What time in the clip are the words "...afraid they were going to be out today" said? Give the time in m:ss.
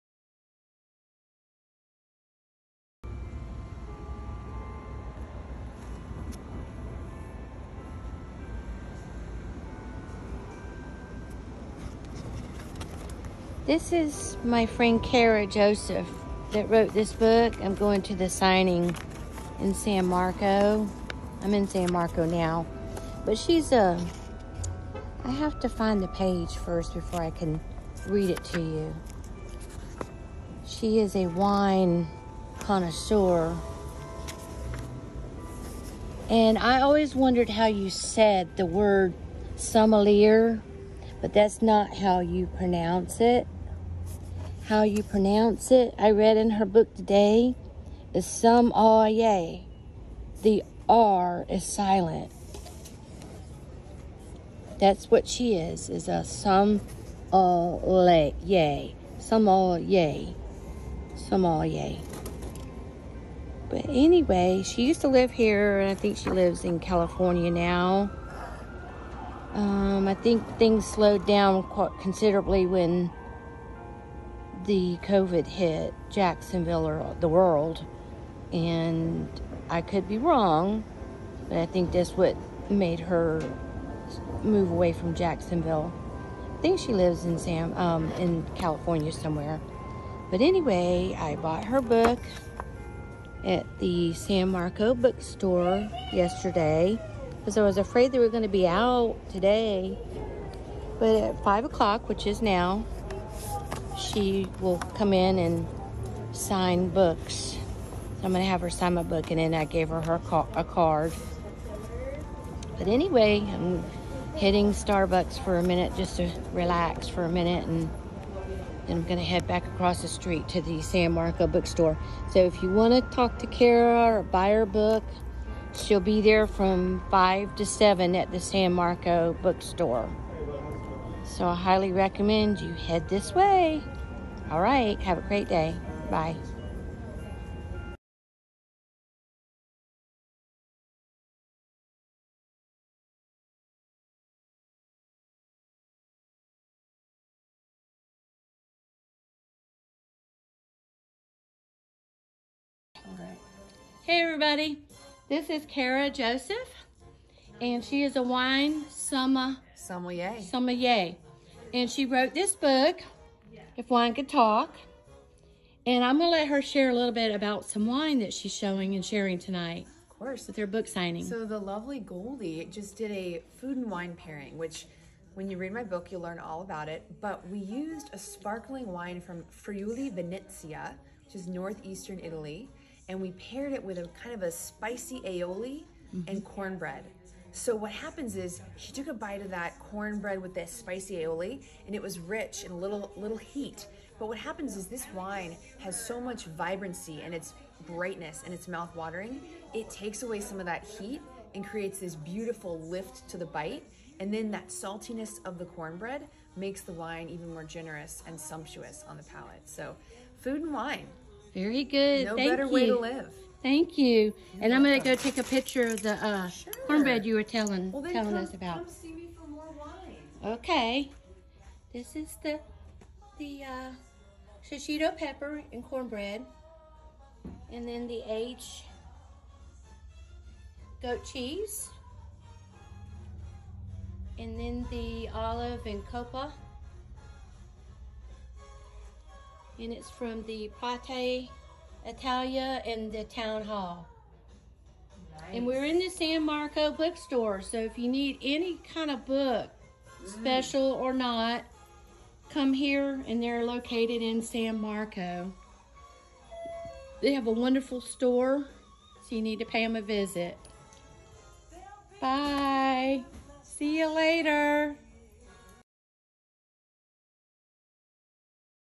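1:37.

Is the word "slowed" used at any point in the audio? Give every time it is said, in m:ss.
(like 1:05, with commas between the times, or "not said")
1:10.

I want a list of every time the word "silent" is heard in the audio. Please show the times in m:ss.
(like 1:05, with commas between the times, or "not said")
0:51.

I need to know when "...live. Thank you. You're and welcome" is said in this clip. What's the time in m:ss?
3:32.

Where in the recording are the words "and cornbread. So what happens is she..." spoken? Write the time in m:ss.
3:06.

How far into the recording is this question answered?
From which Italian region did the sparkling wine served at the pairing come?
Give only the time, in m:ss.
2:59.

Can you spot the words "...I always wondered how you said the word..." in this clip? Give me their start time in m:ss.
0:36.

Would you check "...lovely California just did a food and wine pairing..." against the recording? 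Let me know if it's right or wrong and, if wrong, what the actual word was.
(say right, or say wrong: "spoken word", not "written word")
wrong: "Goldie", not "California".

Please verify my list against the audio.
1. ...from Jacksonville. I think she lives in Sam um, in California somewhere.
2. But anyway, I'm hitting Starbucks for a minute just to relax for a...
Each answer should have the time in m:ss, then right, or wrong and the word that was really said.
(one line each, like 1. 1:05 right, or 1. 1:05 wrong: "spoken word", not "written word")
1. 1:24 right
2. 1:52 right.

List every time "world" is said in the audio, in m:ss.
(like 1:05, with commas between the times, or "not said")
1:17.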